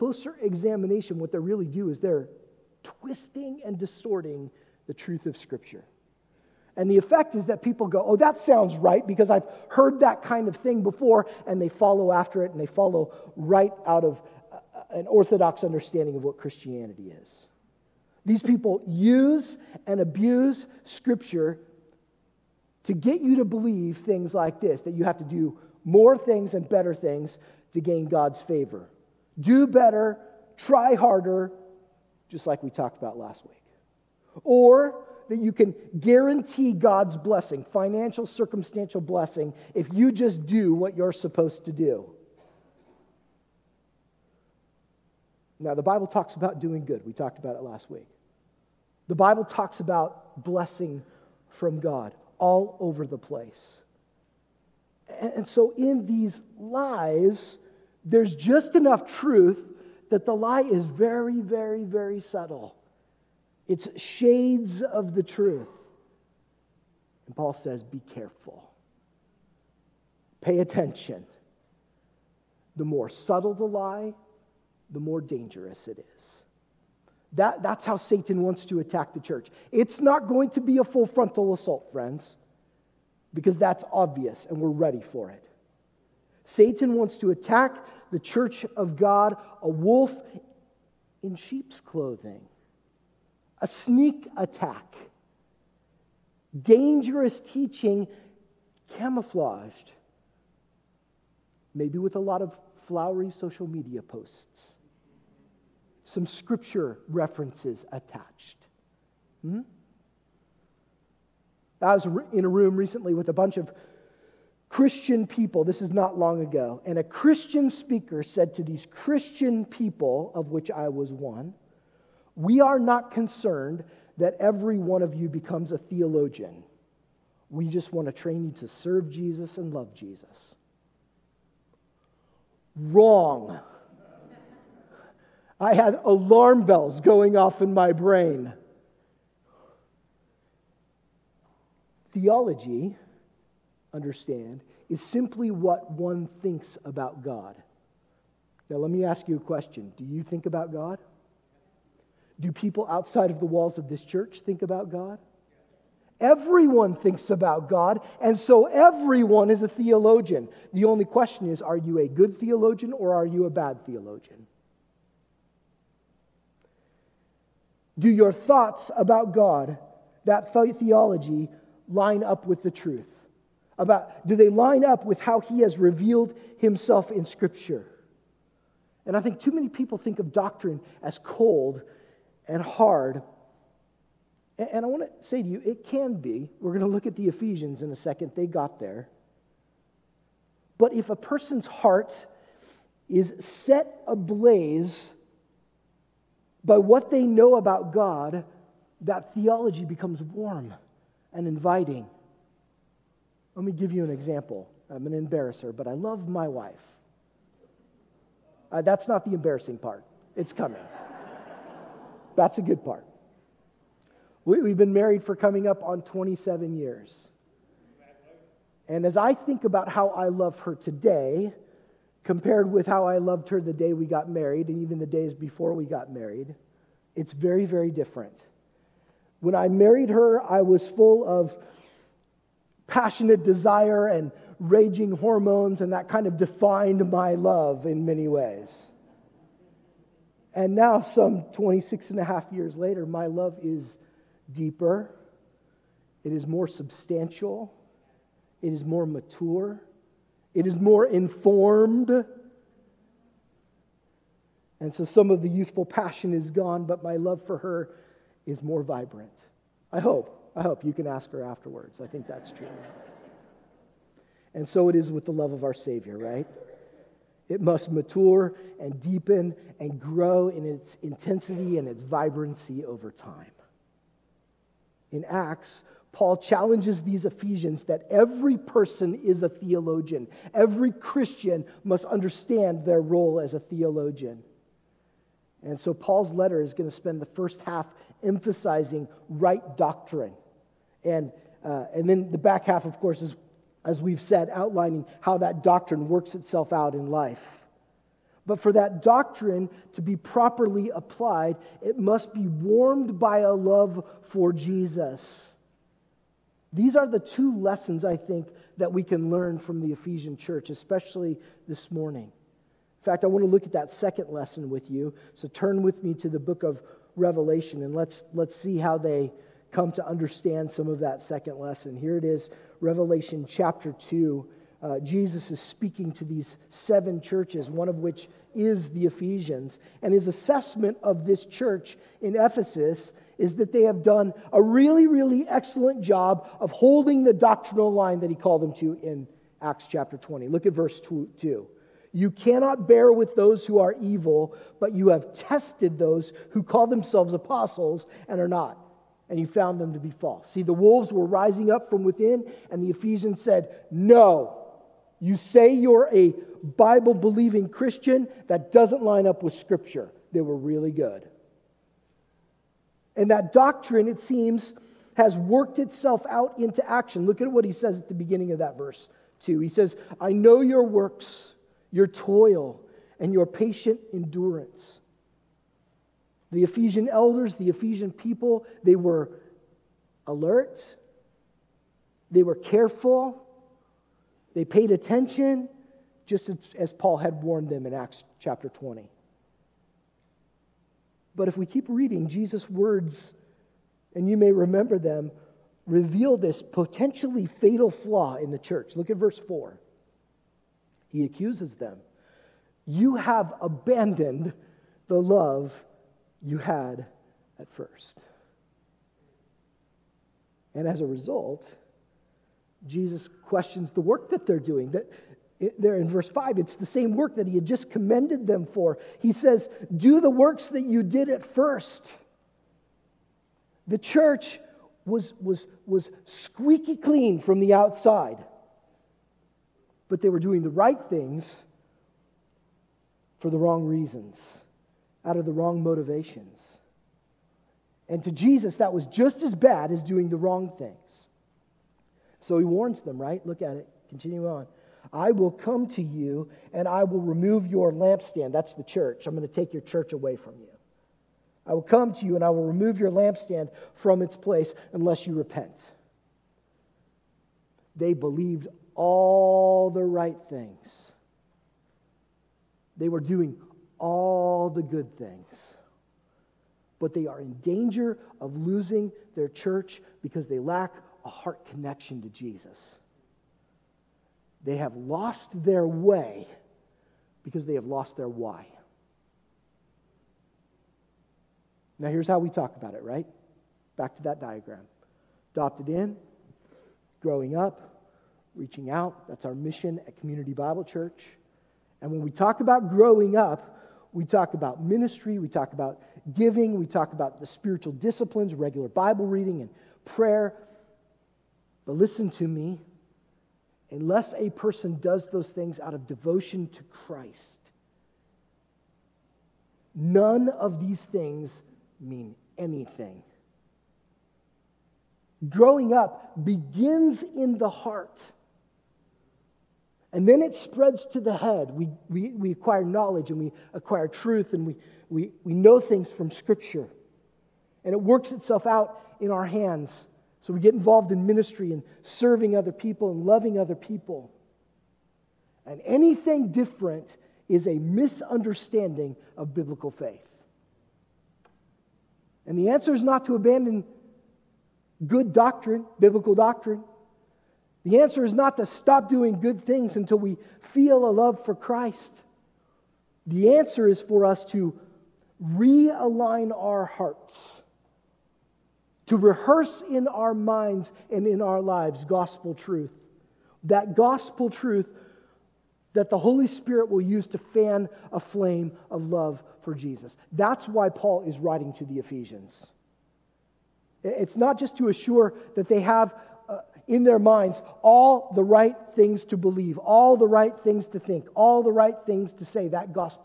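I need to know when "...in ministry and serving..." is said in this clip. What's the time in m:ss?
8:51.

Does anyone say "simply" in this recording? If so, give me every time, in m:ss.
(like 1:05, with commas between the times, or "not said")
2:25.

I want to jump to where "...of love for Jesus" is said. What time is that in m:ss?
9:28.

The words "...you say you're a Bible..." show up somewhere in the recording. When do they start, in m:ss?
5:55.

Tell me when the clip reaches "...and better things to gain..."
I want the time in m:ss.
0:26.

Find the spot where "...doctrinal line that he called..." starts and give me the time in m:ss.
5:37.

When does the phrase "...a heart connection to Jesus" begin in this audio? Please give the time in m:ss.
7:51.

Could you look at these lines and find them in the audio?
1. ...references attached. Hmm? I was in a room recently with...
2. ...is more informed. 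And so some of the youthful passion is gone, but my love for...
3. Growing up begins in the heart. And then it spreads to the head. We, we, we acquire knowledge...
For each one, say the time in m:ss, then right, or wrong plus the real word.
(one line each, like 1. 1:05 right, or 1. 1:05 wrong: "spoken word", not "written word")
1. 1:47 right
2. 4:10 right
3. 8:35 right.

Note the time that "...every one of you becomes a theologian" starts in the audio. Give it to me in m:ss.
2:04.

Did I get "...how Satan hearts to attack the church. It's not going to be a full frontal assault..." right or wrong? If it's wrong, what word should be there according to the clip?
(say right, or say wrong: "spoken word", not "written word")
wrong: "wants", not "hearts".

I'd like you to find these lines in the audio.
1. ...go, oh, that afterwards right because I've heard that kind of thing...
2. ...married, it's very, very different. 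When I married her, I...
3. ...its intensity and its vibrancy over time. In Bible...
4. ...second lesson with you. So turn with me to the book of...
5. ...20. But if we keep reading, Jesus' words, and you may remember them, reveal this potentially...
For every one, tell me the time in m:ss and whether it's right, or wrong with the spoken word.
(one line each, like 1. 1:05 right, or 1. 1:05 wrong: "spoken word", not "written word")
1. 0:07 wrong: "sounds", not "afterwards"
2. 3:46 right
3. 4:30 wrong: "Acts", not "Bible"
4. 5:13 right
5. 6:28 right.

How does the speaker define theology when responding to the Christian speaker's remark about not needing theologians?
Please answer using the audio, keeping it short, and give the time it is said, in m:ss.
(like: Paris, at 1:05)
what one thinks about God, at 2:25.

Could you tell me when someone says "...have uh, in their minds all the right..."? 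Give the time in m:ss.
9:35.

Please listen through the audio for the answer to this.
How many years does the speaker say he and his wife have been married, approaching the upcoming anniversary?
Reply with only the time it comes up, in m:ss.
3:36.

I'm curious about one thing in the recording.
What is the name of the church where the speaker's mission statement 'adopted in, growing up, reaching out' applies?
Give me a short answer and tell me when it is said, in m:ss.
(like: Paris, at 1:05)
Community Bible Church, at 8:10.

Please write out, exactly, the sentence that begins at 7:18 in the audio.
And to Jesus, that was just as bad as doing the wrong things.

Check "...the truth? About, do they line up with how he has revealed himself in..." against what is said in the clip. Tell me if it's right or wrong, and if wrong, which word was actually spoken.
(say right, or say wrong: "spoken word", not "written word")
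right.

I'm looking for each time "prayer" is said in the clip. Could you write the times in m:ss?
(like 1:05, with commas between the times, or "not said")
8:20.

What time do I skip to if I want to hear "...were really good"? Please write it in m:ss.
6:00.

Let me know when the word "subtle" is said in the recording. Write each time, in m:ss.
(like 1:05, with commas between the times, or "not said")
1:02, 1:13.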